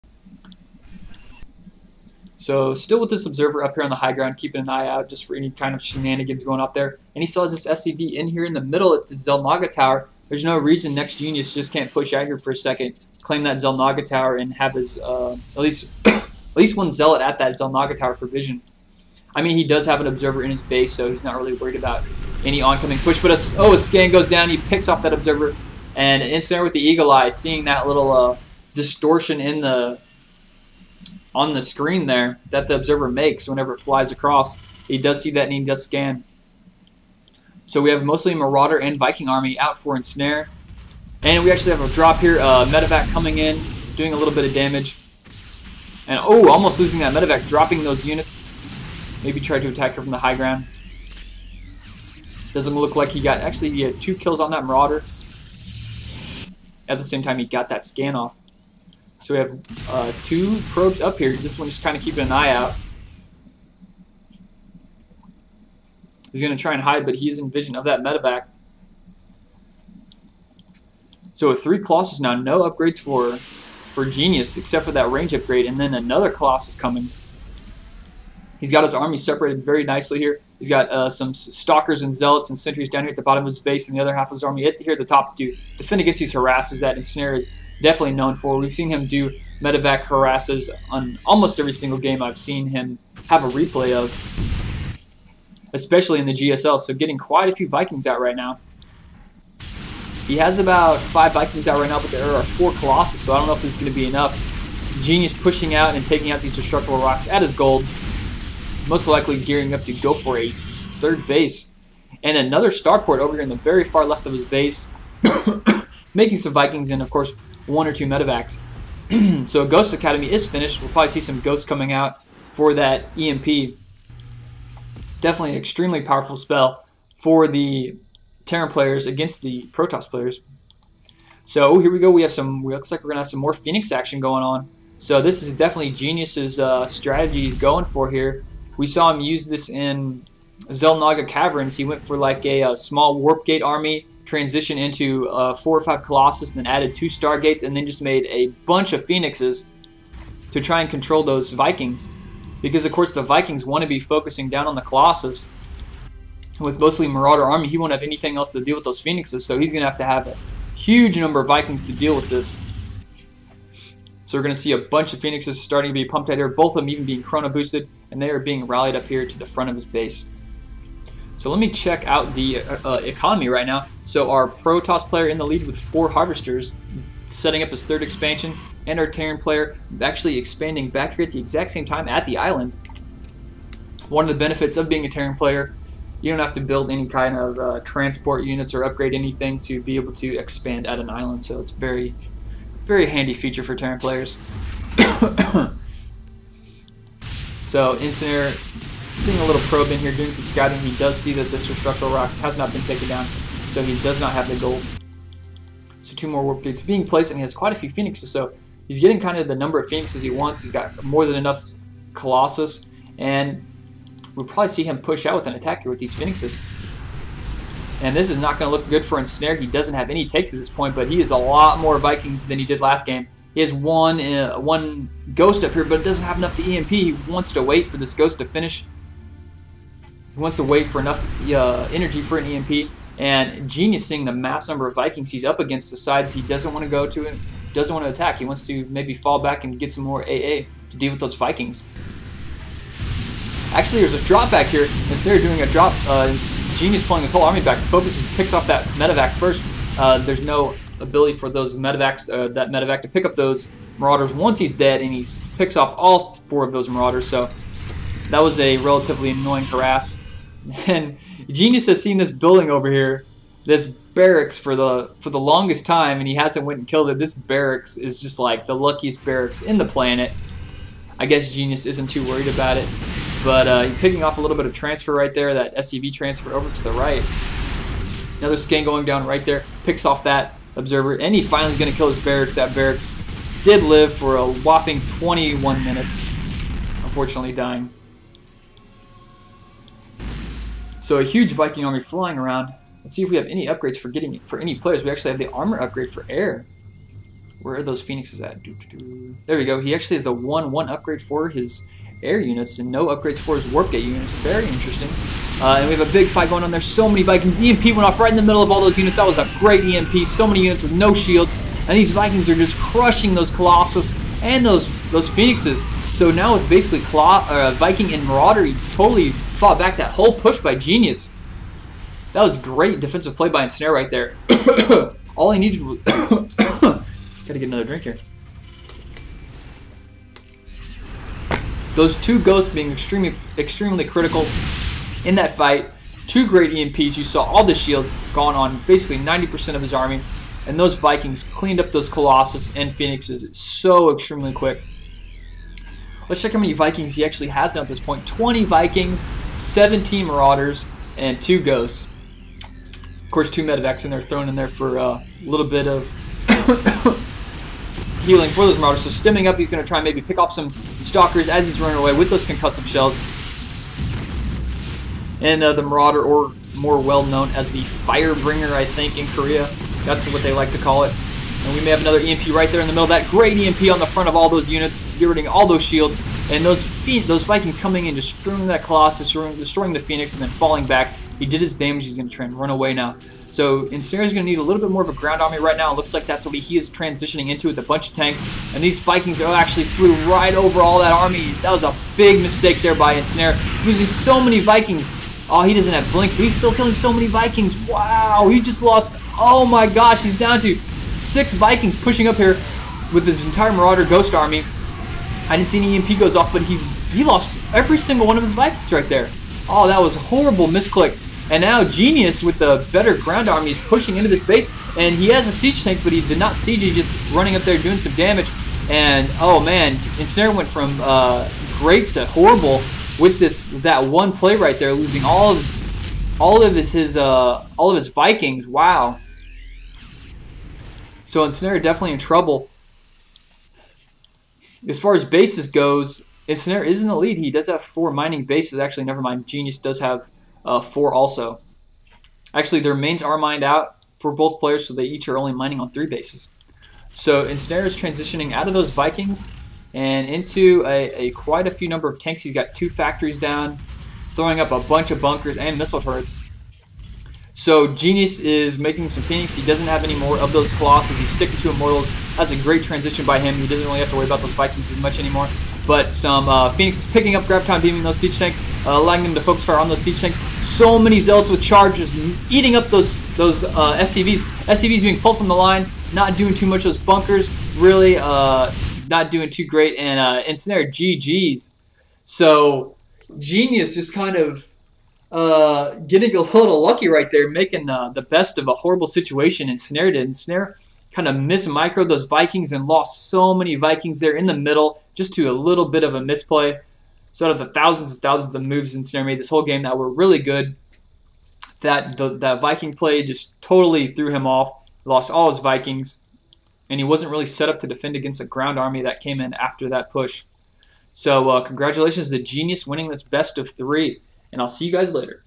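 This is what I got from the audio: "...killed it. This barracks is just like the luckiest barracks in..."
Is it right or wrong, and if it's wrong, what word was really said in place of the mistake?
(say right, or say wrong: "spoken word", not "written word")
right.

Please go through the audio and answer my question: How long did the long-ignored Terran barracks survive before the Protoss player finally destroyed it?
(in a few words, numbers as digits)
21 minutes.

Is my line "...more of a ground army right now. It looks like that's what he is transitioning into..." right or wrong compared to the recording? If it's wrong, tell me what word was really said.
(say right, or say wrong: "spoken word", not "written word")
right.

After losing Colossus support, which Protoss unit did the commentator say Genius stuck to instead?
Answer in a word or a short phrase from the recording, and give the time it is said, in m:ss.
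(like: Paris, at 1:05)
Immortals, at 7:41.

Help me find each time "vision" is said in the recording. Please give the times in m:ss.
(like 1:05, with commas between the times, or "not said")
0:18, 1:07.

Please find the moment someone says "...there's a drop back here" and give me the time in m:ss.
4:04.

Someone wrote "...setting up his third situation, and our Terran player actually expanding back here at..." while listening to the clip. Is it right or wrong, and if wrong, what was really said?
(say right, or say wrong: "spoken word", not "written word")
wrong: "expansion", not "situation".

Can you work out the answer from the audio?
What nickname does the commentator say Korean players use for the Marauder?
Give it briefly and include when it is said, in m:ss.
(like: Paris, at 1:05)
Firebringer, at 6:07.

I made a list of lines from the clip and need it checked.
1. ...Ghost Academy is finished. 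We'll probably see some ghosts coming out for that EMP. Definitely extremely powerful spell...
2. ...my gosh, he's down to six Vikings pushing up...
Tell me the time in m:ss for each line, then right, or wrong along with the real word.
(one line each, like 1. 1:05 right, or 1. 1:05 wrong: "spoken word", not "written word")
1. 1:59 right
2. 6:39 right.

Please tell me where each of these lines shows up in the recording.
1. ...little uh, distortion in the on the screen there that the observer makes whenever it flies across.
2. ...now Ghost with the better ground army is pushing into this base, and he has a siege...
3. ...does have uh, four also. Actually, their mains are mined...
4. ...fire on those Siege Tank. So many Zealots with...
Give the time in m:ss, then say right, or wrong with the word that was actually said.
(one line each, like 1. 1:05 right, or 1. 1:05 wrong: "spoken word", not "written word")
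1. 0:27 right
2. 6:51 wrong: "Genius", not "Ghost"
3. 7:19 right
4. 7:49 right.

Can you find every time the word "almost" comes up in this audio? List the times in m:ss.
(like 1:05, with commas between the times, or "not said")
0:46, 1:31.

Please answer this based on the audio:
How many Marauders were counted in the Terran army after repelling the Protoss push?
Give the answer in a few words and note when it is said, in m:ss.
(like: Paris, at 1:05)
17, at 5:49.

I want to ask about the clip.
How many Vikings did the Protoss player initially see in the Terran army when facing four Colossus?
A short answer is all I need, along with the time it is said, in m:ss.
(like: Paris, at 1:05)
5, at 1:40.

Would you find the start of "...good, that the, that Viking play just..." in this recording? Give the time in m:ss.
8:20.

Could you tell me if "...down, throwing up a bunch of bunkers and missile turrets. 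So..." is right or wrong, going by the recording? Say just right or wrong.
right.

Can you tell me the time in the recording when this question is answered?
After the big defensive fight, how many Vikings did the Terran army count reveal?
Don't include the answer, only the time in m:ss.
5:48.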